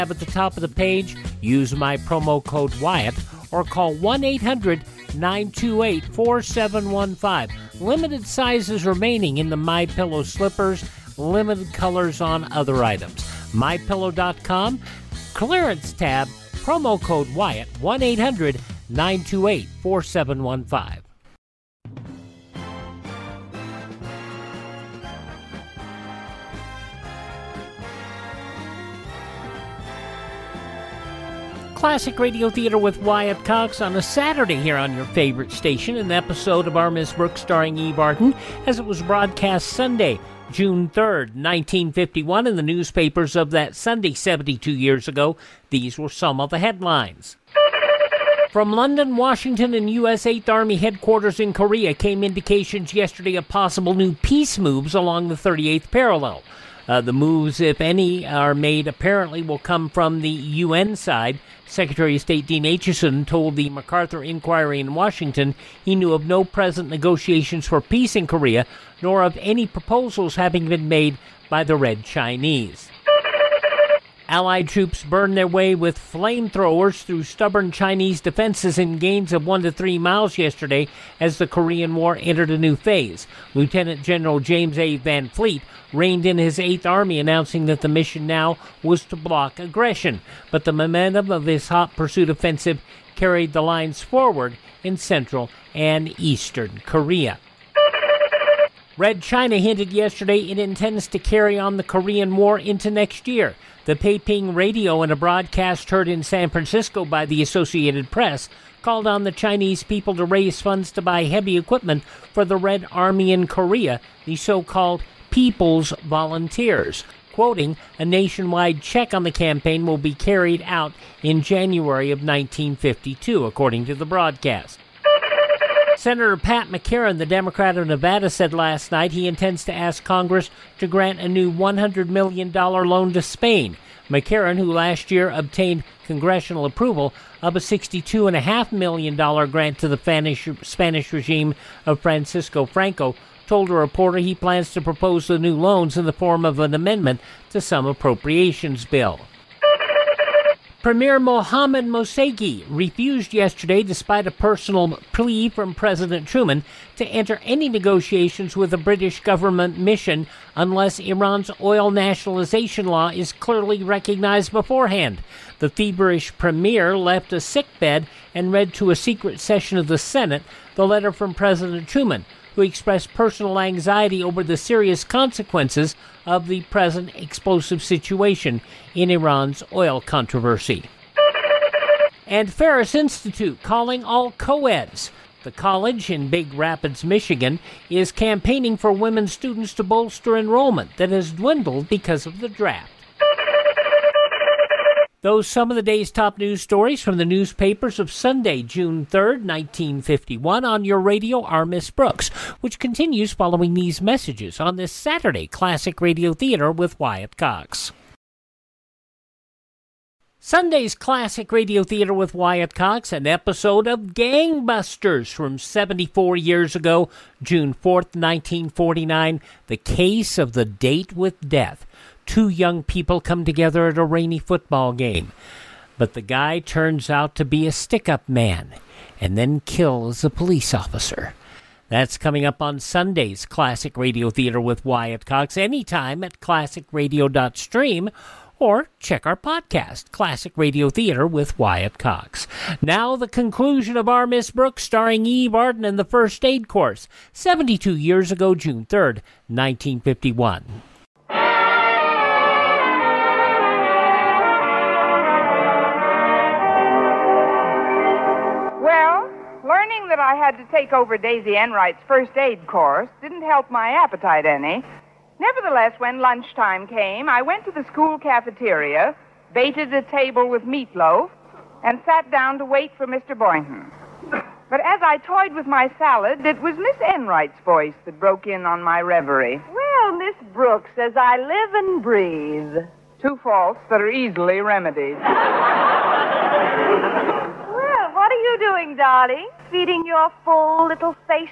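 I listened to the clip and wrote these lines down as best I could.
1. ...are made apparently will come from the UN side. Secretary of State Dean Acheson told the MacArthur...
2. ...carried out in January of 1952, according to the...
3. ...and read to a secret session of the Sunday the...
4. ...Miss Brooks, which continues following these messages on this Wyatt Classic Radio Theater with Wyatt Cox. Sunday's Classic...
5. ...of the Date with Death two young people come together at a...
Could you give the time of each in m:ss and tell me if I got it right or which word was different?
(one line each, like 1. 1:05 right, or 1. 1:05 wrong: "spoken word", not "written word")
1. 0:58 right
2. 2:00 right
3. 2:48 wrong: "Senate", not "Sunday"
4. 3:21 wrong: "Saturday", not "Wyatt"
5. 3:40 right.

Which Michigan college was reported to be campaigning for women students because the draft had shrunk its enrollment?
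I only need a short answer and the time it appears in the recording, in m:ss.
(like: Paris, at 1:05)
Ferris Institute, at 3:02.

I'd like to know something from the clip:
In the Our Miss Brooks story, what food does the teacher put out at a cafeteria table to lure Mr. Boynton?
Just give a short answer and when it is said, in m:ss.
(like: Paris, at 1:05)
meatloaf, at 4:30.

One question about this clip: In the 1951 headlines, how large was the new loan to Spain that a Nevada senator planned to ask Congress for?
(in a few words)
$100 million.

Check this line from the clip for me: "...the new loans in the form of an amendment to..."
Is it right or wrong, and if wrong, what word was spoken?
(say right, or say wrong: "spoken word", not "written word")
right.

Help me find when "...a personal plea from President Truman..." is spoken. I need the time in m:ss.
2:34.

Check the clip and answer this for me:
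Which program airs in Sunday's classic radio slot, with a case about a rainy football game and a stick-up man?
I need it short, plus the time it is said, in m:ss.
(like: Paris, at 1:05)
Gangbusters, at 3:34.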